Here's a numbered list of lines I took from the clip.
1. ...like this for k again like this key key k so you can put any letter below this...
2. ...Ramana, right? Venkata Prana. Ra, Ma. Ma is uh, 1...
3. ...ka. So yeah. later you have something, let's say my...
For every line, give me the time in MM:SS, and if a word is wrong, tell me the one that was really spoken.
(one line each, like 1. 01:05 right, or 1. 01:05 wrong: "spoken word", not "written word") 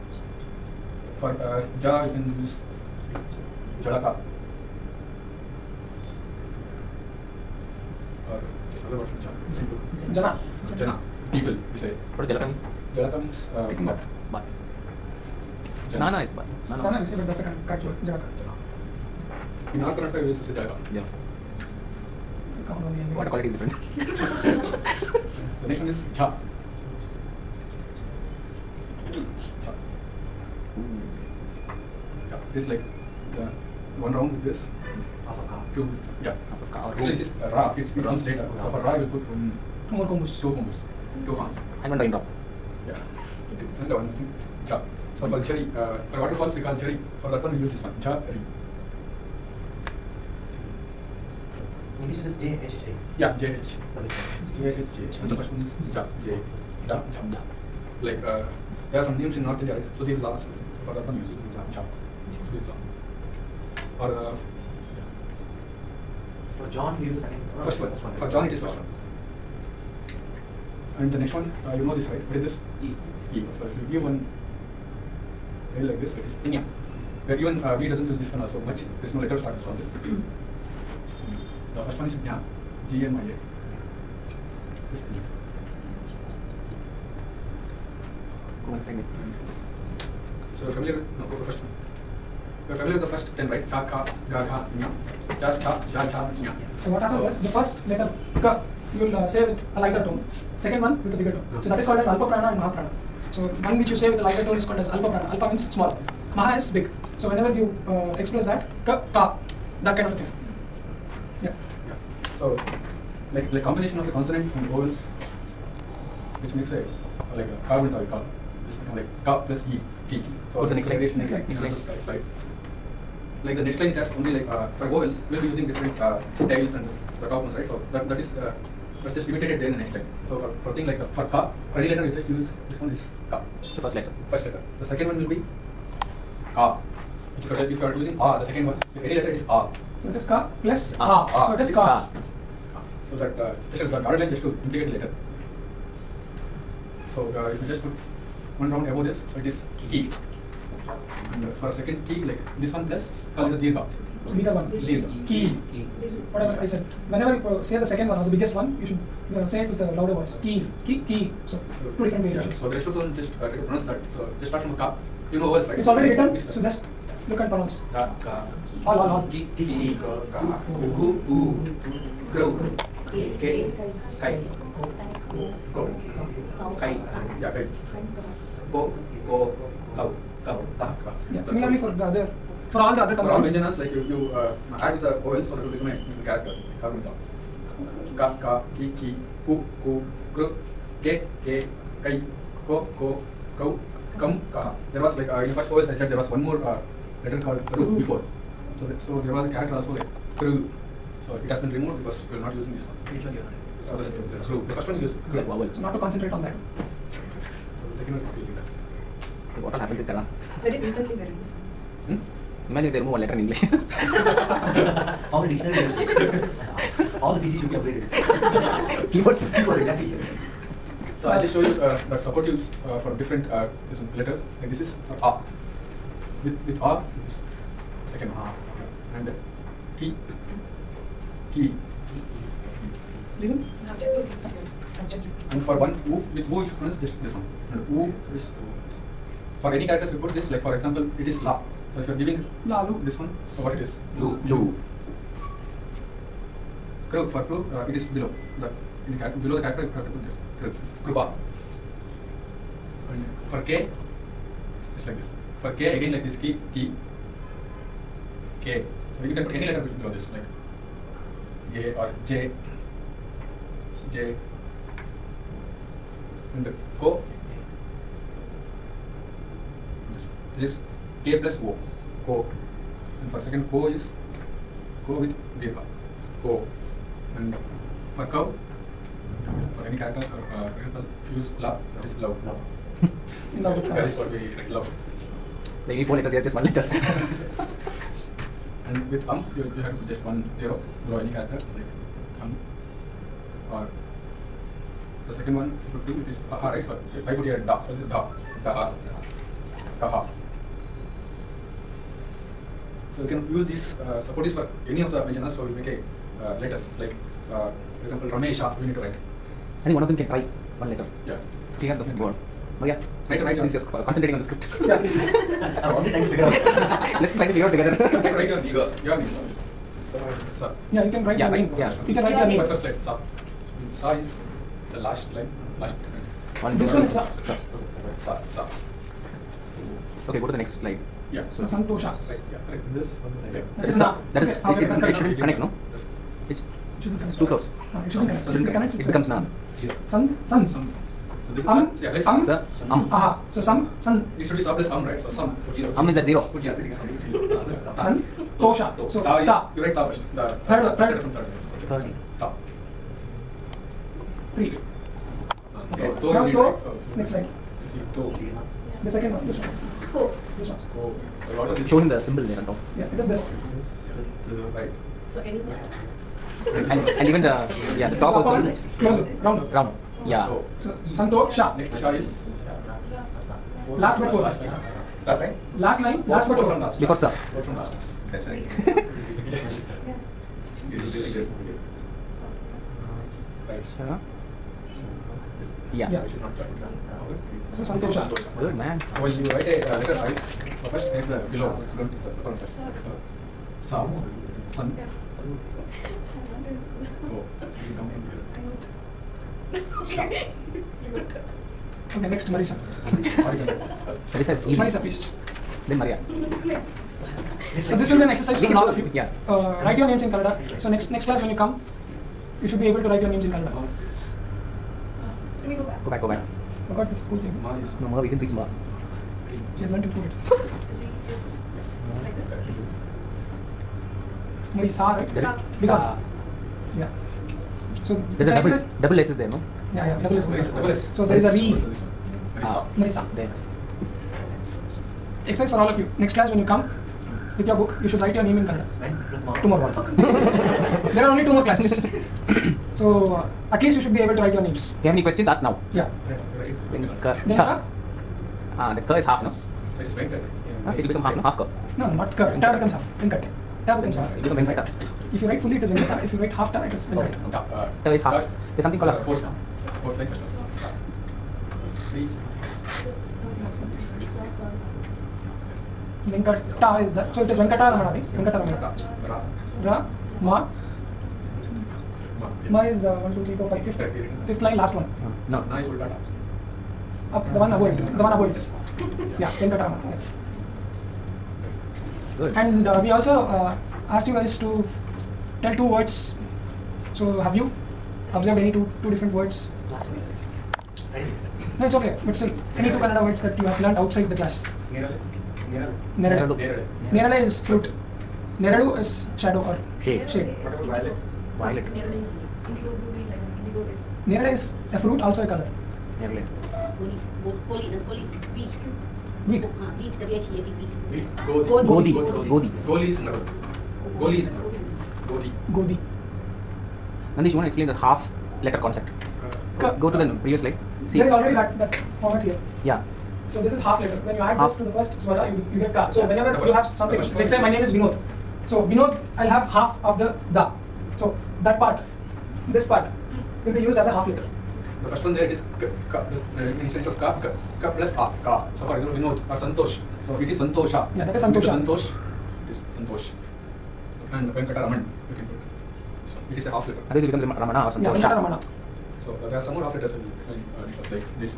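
1. 04:15 right
2. 07:47 wrong: "Ramana", not "Prana"
3. 08:45 wrong: "whenever", not "later".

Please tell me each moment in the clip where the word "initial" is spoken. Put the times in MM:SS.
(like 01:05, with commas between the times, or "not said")
08:56.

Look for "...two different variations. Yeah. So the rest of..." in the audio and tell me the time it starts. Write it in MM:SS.
02:41.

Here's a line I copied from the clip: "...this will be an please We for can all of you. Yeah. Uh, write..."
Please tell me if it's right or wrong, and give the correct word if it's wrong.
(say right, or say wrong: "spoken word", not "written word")
wrong: "exercise", not "please".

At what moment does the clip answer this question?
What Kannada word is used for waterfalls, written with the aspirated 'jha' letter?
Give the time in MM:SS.
00:48.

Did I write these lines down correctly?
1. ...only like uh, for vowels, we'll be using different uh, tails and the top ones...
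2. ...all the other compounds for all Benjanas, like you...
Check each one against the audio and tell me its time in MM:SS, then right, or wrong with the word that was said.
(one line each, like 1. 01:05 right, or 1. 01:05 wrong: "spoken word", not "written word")
1. 02:04 right
2. 03:02 right.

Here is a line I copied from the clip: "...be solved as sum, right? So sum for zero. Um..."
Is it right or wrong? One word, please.
right.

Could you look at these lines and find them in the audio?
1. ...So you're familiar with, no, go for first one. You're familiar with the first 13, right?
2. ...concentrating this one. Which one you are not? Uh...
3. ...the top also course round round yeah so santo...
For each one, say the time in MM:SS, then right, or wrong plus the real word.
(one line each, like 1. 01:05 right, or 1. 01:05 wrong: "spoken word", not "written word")
1. 01:30 wrong: "10", not "13"
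2. 03:22 wrong: "using", not "concentrating"
3. 06:08 wrong: "close", not "course".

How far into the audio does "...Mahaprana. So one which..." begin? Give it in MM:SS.
01:42.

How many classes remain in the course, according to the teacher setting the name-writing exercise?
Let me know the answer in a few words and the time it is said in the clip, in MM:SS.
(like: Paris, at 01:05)
2, at 07:21.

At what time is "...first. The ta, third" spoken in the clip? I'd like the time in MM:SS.
05:50.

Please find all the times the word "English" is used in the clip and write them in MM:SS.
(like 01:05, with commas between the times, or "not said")
00:52, 03:33.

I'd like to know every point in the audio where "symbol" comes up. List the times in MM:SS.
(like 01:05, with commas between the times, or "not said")
06:02.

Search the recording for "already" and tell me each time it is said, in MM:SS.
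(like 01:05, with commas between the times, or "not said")
02:45, 05:15, 08:41.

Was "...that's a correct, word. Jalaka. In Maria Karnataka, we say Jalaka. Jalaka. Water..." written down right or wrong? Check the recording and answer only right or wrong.
wrong.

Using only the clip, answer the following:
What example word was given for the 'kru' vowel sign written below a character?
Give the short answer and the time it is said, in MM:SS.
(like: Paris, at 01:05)
Krupa, at 04:11.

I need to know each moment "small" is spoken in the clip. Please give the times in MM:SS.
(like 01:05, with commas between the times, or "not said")
01:45.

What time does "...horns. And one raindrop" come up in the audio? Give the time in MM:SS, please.
00:41.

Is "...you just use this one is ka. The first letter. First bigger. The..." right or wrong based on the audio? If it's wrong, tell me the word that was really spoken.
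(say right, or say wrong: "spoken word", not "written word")
wrong: "letter", not "bigger".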